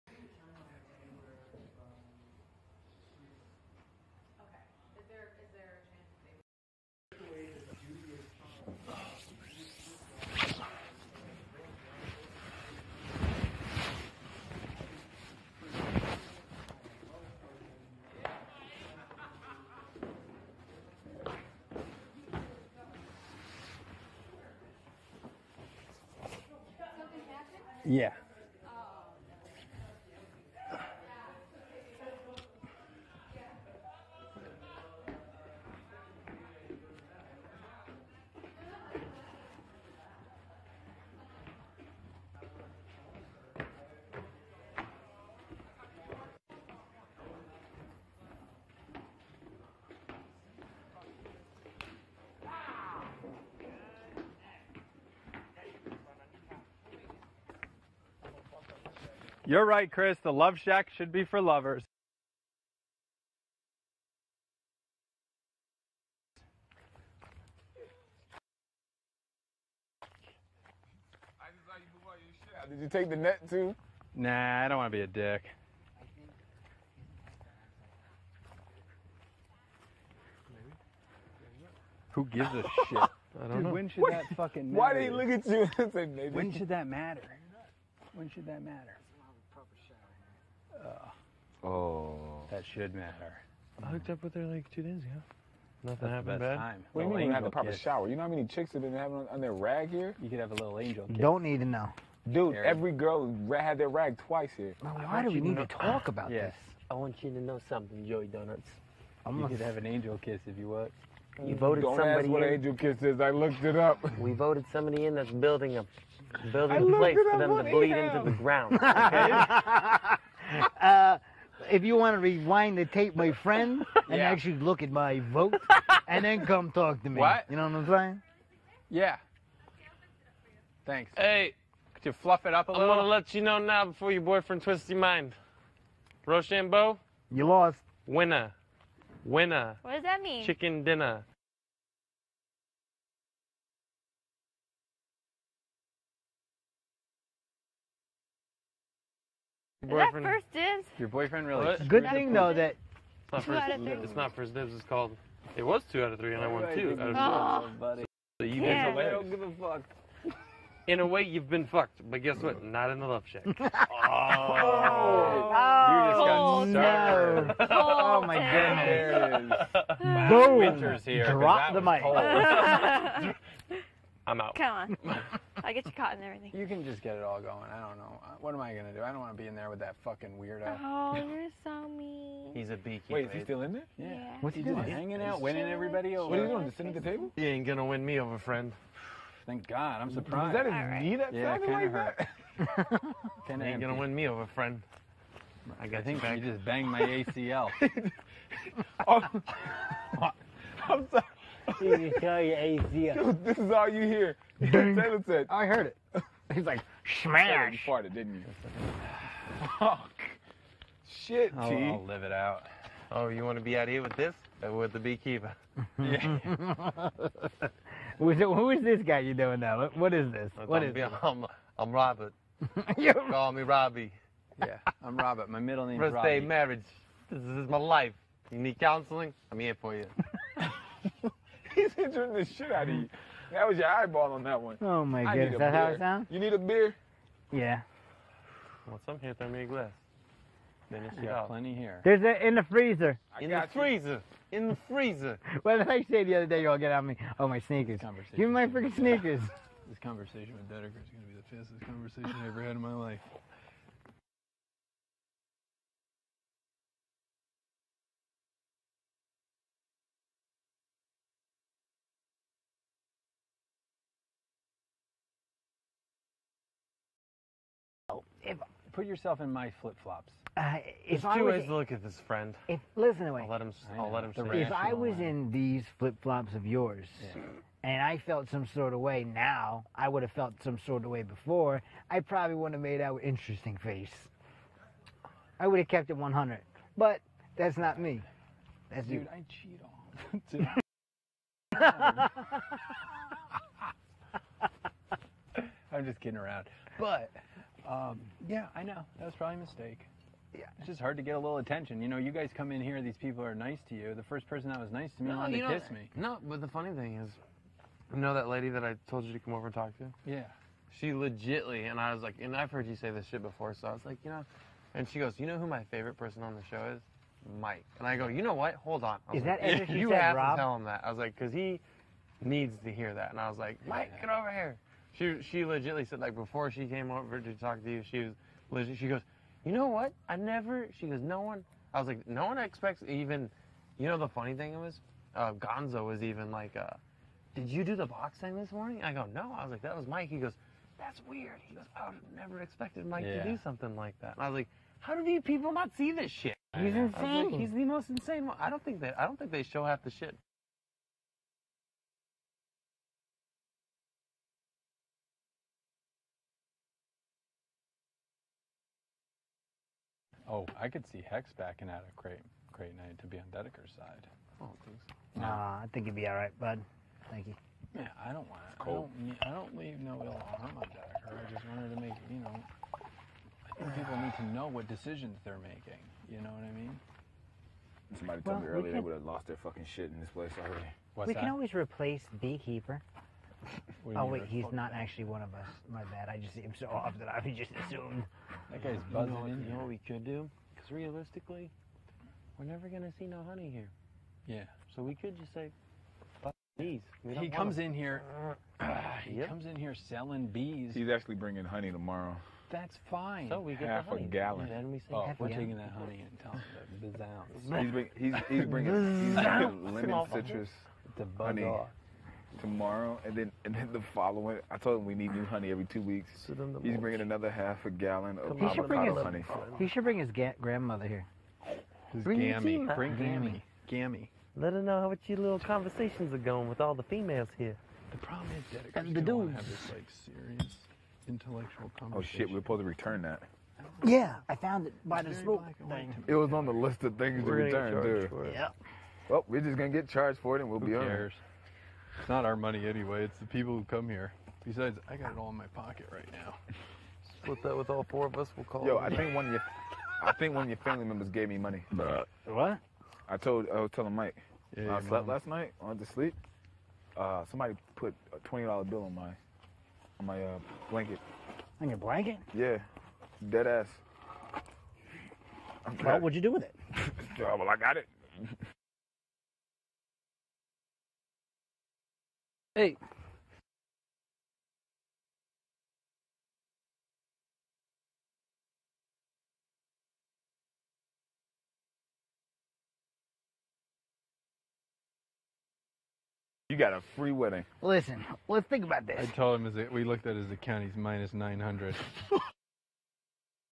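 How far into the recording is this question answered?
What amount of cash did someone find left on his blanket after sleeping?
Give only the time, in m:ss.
7:38.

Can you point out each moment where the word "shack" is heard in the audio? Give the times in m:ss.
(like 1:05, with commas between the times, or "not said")
1:00, 2:43.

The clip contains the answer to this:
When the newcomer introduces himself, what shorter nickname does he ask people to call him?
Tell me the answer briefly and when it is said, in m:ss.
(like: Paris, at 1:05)
Robbie, at 3:43.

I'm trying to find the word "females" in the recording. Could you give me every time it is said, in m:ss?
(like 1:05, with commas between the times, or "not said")
7:07.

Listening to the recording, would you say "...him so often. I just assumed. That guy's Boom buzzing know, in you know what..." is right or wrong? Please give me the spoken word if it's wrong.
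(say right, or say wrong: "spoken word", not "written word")
wrong: "You", not "Boom".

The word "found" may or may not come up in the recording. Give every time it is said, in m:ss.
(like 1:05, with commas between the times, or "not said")
7:14.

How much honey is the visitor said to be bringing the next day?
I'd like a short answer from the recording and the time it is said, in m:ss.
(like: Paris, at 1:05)
Half a gallon, at 6:43.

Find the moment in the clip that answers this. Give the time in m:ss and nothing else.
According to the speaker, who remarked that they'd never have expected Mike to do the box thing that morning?
5:35.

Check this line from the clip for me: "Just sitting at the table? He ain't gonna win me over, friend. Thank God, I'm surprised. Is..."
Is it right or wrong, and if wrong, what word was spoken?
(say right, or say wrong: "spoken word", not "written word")
right.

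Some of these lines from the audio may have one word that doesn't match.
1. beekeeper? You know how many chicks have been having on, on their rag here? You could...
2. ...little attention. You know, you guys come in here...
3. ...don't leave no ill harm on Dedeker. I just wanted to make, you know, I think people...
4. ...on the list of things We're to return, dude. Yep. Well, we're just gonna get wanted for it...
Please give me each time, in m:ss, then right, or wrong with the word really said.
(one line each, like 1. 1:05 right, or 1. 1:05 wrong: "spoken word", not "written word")
1. 1:37 wrong: "shower", not "beekeeper"
2. 5:01 right
3. 6:09 right
4. 7:16 wrong: "charged", not "wanted".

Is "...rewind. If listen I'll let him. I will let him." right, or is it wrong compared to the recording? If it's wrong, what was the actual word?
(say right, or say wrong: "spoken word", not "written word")
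wrong: "friend", not "rewind".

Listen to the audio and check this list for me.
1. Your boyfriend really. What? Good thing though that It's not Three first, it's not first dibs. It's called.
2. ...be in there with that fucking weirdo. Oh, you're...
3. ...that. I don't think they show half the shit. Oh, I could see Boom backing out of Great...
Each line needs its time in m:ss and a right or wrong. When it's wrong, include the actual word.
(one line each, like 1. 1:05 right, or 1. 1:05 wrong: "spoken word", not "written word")
1. 2:30 wrong: "Two", not "Three"
2. 2:59 right
3. 5:49 wrong: "Hex", not "Boom".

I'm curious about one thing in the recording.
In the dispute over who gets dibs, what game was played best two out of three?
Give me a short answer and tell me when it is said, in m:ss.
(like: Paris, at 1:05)
Rochambeau, at 2:16.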